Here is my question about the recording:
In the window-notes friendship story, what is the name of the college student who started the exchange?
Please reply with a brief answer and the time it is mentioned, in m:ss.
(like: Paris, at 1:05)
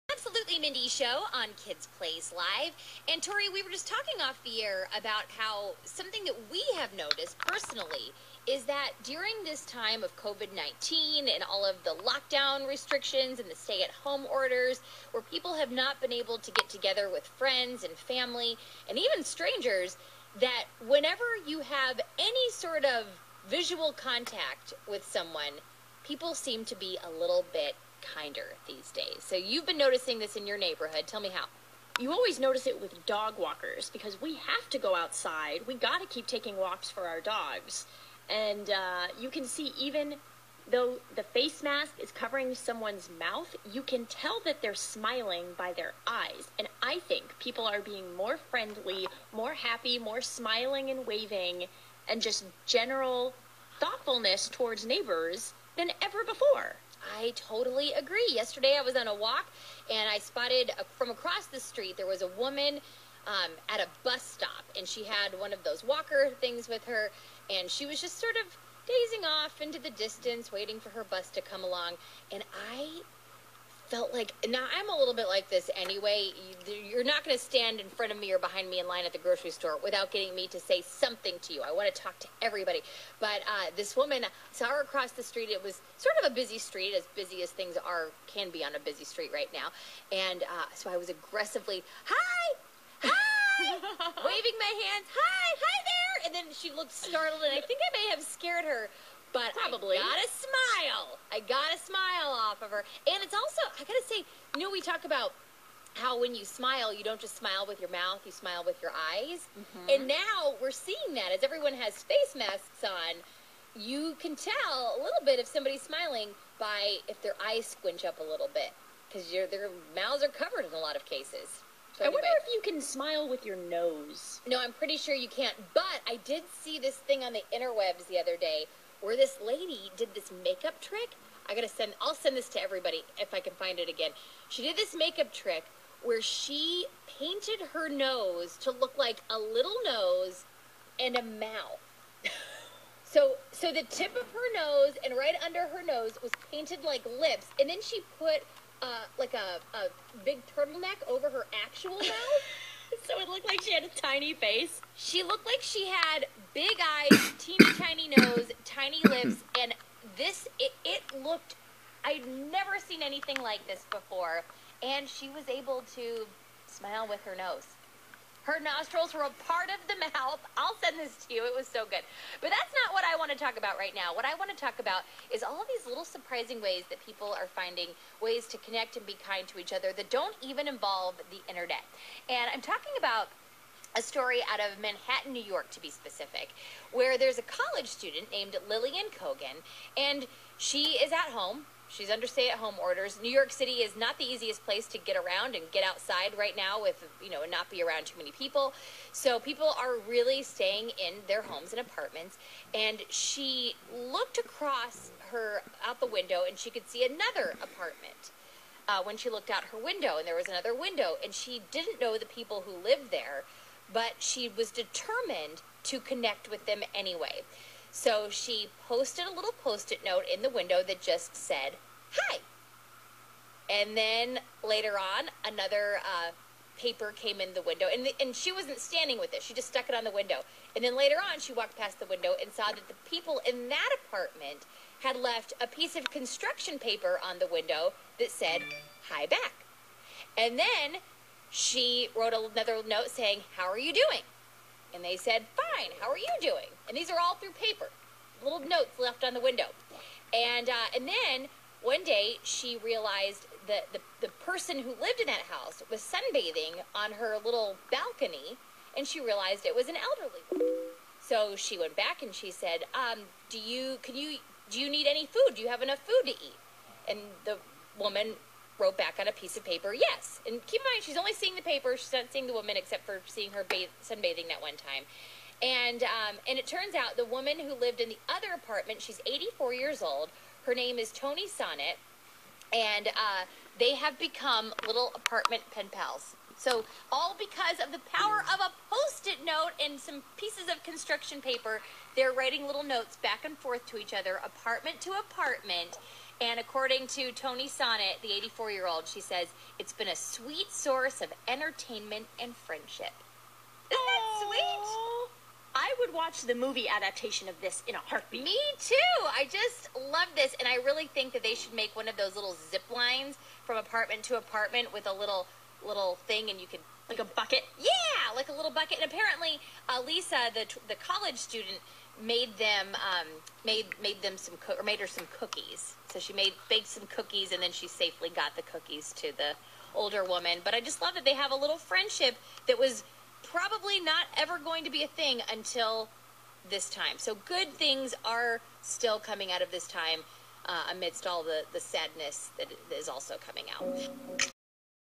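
Lillian Kogan, at 3:08.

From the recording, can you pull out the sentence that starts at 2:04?
No, I'm pretty sure you can't.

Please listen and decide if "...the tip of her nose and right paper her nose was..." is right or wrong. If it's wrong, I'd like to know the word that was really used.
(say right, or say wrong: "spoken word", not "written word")
wrong: "under", not "paper".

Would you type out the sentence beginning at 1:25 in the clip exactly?
It was sort of a busy street, as busy as things are can be on a busy street right now.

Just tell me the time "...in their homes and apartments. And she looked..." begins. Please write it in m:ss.
3:20.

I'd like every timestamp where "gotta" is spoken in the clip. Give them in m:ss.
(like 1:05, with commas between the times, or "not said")
1:43, 2:11.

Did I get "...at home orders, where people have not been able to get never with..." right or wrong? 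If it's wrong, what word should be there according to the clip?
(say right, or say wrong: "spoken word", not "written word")
wrong: "together", not "never".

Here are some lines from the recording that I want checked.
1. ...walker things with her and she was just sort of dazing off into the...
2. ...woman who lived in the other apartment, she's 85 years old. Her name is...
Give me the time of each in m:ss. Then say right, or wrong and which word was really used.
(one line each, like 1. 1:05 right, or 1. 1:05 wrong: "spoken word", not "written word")
1. 1:05 right
2. 4:37 wrong: "84", not "85".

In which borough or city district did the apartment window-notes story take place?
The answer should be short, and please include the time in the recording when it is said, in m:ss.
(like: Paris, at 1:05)
Manhattan, at 3:04.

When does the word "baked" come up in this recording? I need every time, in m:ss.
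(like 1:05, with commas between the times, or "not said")
5:26.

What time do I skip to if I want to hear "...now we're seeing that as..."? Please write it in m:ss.
1:50.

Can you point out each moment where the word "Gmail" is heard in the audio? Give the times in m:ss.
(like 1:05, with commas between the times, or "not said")
not said.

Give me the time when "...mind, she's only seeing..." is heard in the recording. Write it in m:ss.
4:30.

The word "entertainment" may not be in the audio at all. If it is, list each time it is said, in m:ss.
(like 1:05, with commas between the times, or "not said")
5:01.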